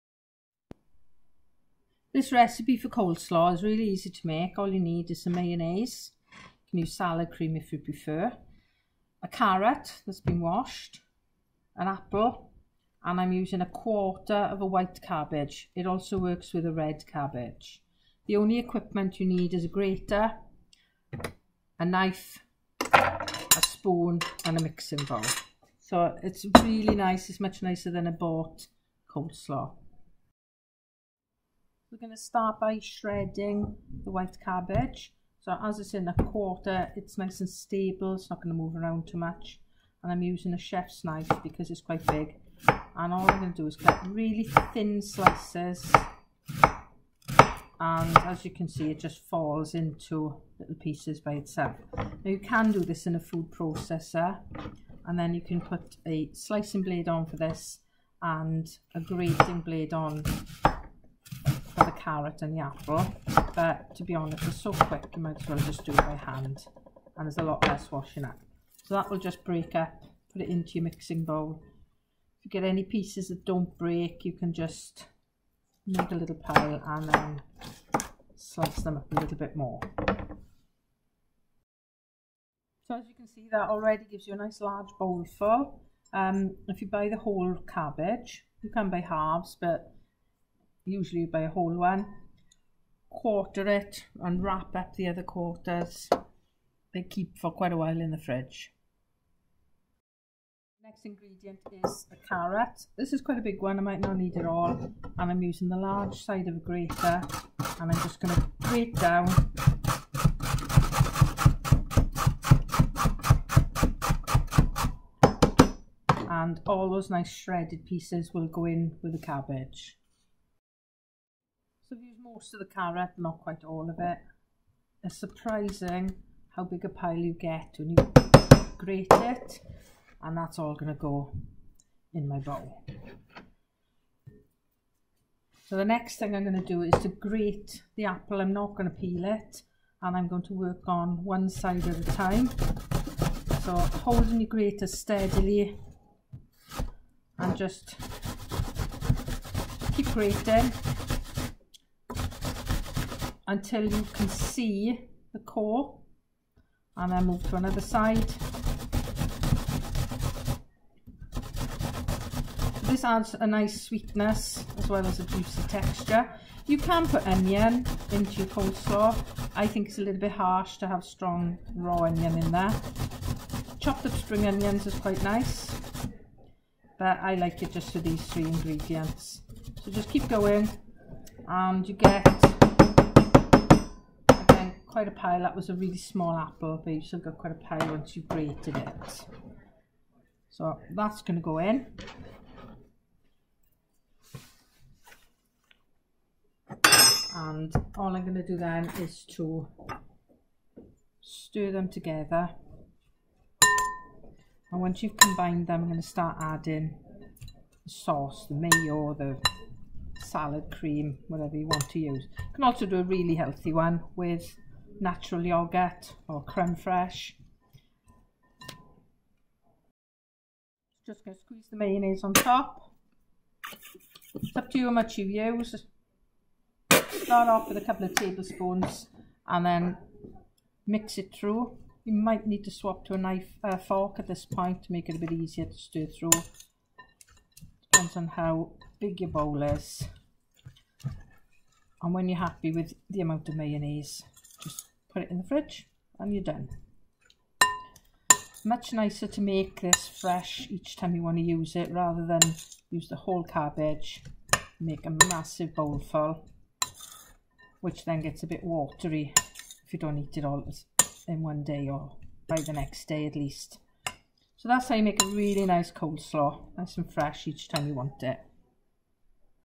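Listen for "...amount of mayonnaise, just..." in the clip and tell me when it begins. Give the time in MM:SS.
04:03.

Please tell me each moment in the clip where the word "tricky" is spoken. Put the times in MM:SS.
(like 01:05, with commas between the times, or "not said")
not said.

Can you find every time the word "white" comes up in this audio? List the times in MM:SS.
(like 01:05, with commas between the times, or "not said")
00:14, 00:34.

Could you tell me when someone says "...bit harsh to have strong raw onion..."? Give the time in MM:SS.
02:50.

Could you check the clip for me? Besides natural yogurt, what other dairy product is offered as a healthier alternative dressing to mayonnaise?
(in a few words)
Creme fraiche.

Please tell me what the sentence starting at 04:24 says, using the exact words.
So that's how you make a really nice coleslaw, nice and fresh each time you want it.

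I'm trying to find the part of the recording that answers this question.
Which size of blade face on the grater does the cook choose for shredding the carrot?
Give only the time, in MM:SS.
01:45.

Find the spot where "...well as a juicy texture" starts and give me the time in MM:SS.
02:44.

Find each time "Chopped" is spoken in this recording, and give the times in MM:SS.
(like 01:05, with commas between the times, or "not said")
02:53.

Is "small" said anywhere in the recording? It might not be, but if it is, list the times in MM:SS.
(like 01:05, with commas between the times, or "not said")
03:05.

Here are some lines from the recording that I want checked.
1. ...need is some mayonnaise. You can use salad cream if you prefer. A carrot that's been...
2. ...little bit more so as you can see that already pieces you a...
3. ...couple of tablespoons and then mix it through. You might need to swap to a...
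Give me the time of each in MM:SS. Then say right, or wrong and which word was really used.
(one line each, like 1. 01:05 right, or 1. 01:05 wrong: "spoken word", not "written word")
1. 00:04 right
2. 01:19 wrong: "gives", not "pieces"
3. 03:47 right.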